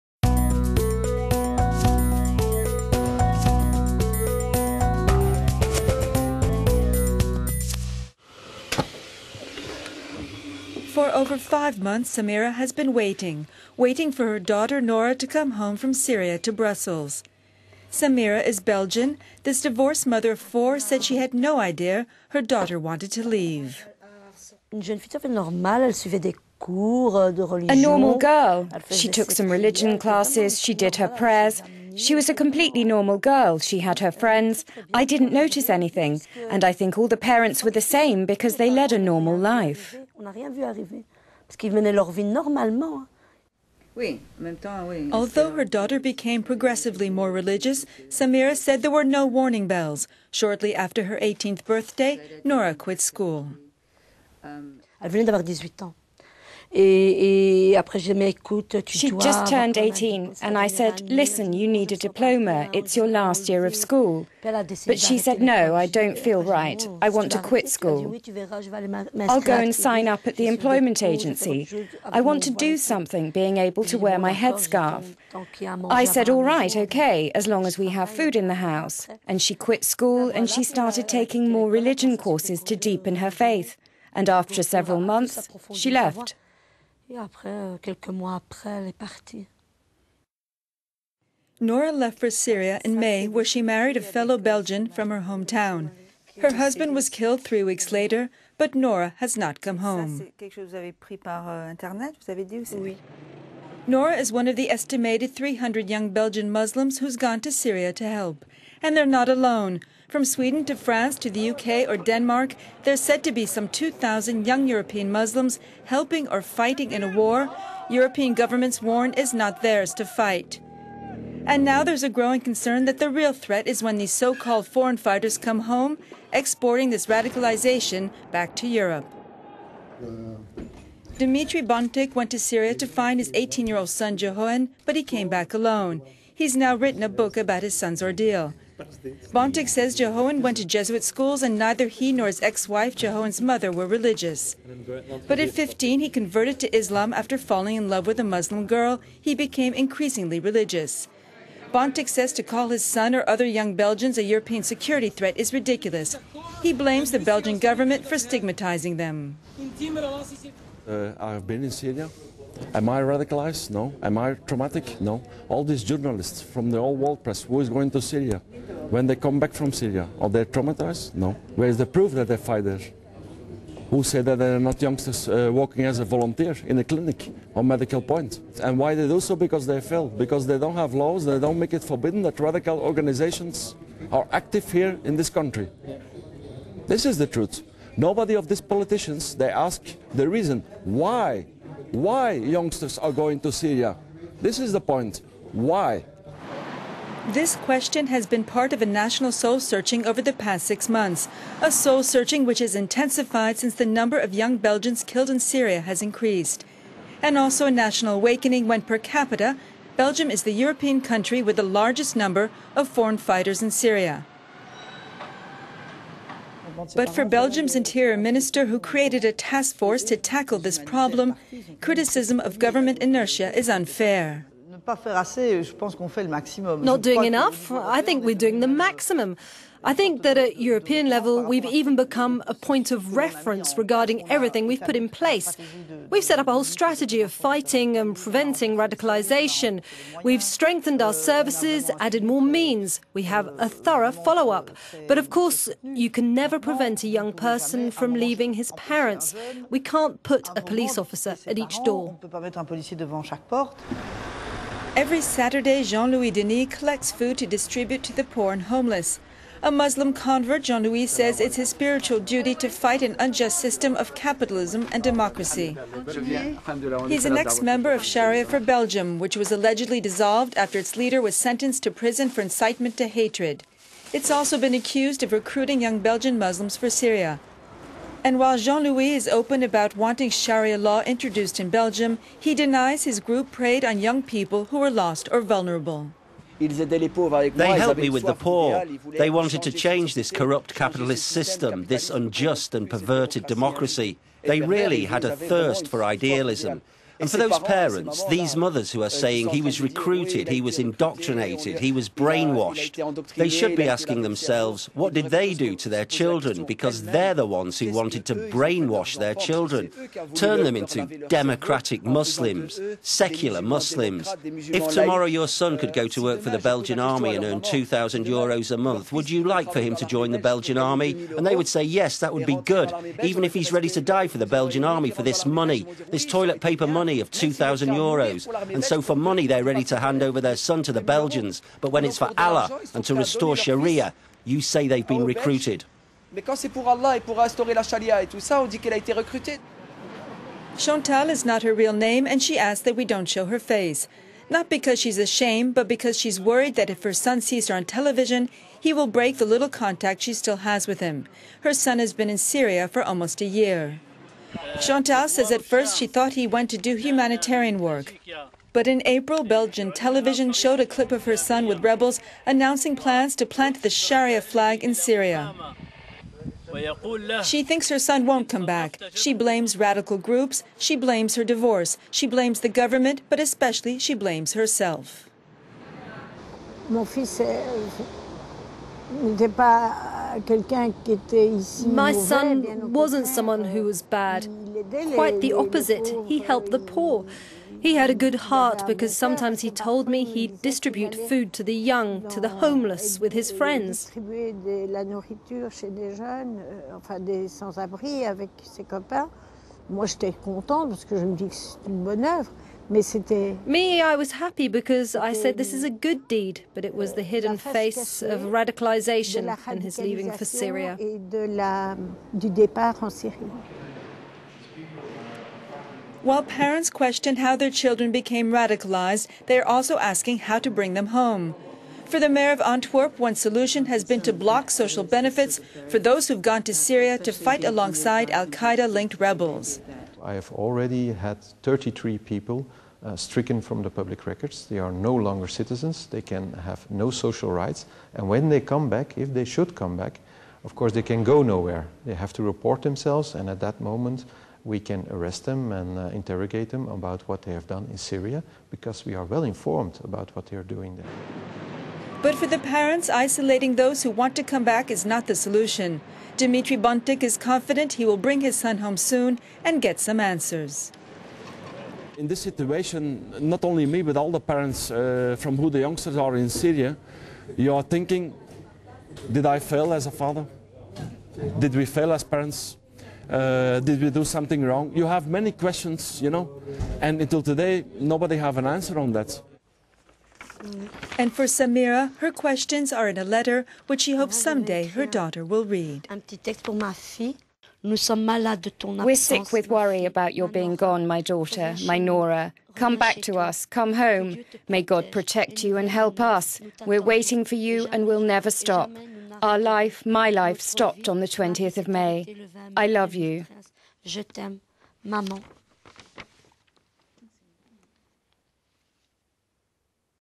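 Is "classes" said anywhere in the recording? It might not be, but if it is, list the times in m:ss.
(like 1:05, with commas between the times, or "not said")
0:29.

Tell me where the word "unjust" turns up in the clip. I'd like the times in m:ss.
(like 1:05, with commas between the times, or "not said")
4:23, 4:52.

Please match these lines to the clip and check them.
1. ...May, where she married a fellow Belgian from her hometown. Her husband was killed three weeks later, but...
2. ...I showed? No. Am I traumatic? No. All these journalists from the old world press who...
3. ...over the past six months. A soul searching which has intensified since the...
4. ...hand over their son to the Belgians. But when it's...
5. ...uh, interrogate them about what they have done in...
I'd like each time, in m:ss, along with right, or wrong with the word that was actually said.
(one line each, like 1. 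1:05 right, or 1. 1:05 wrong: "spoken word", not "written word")
1. 1:32 right
2. 2:42 wrong: "radicalized", not "showed"
3. 3:20 right
4. 5:29 right
5. 7:25 right.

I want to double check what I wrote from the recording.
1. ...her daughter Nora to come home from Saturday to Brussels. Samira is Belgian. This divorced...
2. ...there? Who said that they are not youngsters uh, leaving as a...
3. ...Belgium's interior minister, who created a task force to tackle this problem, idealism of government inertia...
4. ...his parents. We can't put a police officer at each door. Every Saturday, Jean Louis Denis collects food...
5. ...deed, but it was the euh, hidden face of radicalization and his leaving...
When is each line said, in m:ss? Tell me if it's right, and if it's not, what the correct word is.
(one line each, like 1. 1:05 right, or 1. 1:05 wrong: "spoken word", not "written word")
1. 0:14 wrong: "Syria", not "Saturday"
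2. 2:52 wrong: "working", not "leaving"
3. 3:37 wrong: "criticism", not "idealism"
4. 4:08 right
5. 6:46 right.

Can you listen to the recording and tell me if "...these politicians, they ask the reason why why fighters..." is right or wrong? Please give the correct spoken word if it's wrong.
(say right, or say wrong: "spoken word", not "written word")
wrong: "youngsters", not "fighters".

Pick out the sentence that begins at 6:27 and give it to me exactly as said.
He had a good heart because sometimes he told me he'd distribute food to the young, to the homeless, with his friends.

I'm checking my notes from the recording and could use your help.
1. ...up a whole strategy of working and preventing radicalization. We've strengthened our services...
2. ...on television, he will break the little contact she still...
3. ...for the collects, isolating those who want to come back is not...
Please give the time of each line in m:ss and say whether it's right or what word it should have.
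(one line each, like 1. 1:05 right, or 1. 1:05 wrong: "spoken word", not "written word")
1. 3:56 wrong: "fighting", not "working"
2. 5:47 right
3. 7:32 wrong: "parents", not "collects".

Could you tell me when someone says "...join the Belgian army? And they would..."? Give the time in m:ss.
5:20.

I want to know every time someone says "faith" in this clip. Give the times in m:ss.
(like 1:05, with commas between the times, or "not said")
1:23.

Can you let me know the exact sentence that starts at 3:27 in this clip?
And also a national awakening when, per capita, Belgium is the European country with the largest number of foreign fighters in Syria.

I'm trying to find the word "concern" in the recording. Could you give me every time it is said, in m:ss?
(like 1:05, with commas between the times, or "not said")
2:02.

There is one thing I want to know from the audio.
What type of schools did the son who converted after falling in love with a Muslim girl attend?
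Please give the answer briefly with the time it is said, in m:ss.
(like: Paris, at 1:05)
Jesuit schools, at 2:20.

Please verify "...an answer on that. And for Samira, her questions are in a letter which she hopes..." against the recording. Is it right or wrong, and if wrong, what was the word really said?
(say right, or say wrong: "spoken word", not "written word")
right.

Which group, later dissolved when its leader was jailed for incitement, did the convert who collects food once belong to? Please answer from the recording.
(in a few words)
Sharia for Belgium.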